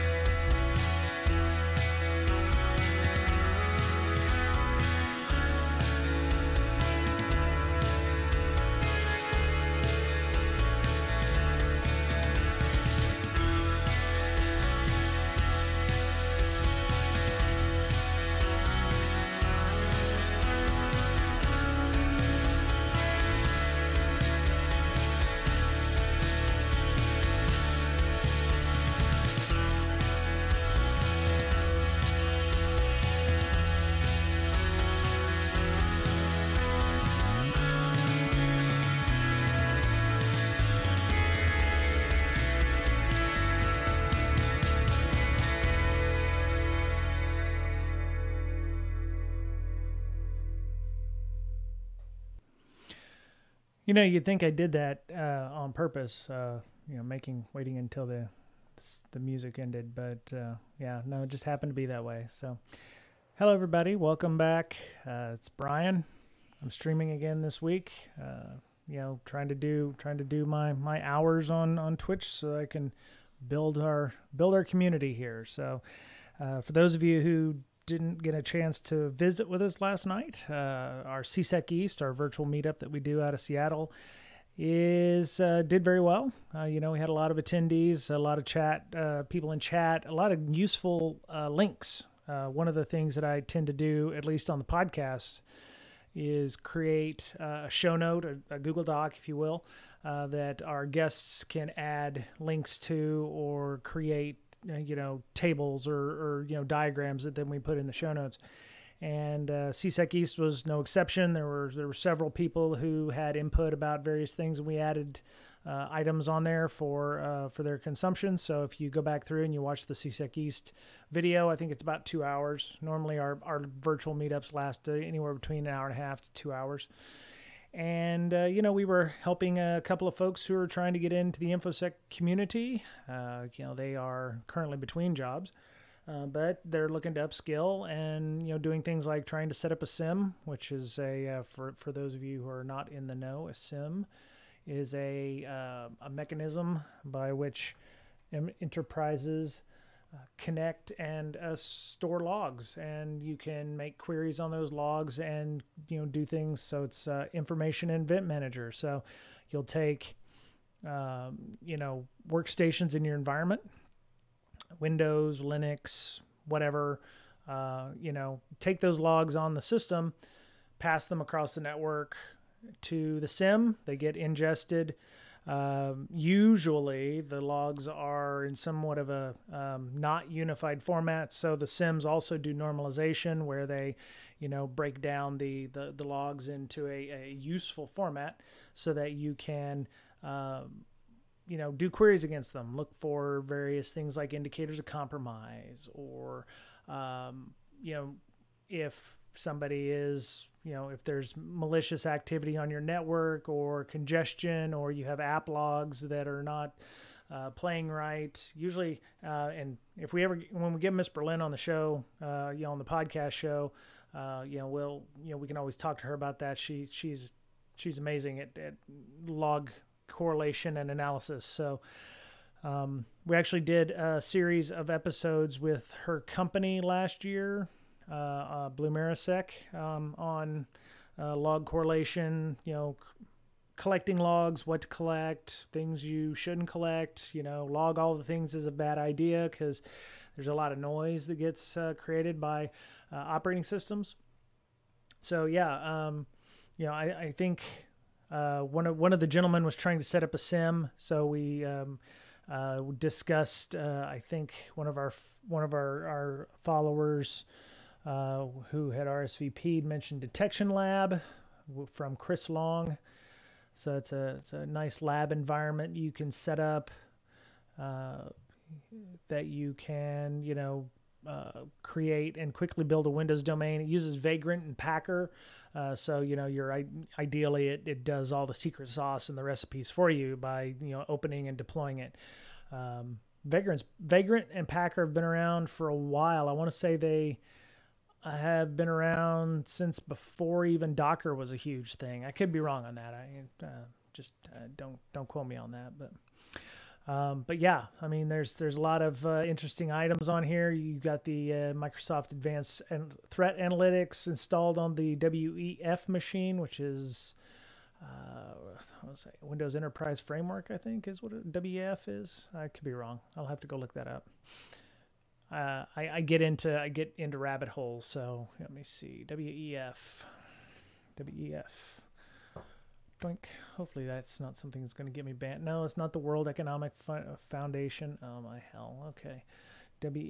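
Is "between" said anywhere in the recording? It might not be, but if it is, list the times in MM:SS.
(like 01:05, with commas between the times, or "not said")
02:05, 02:14.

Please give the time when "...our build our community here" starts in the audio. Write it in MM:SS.
01:13.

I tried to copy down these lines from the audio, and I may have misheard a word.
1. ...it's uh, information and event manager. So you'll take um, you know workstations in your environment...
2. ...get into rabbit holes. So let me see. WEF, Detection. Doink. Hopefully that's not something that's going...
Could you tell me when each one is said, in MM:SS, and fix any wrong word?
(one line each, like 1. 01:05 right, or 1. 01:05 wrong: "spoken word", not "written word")
1. 02:36 right
2. 05:16 wrong: "WEF", not "Detection".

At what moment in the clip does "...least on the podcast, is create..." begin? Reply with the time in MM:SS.
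01:34.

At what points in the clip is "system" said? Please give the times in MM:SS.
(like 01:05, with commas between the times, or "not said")
02:49, 04:03.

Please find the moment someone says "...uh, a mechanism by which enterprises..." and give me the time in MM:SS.
02:25.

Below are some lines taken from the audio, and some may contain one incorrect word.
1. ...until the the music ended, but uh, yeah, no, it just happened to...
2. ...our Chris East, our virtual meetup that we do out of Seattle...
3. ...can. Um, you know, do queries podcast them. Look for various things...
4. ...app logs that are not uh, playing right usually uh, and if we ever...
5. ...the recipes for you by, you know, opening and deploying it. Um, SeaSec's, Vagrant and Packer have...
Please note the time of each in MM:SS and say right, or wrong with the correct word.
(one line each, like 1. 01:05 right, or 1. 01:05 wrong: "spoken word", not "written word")
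1. 00:57 right
2. 01:21 wrong: "SeaSec", not "Chris"
3. 03:09 wrong: "against", not "podcast"
4. 03:25 right
5. 04:39 wrong: "Vagrant", not "SeaSec".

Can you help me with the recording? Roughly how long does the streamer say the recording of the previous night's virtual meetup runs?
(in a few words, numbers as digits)
about two hours.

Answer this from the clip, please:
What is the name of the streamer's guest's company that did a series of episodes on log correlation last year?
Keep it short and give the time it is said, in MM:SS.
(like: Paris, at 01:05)
Marisec, at 03:48.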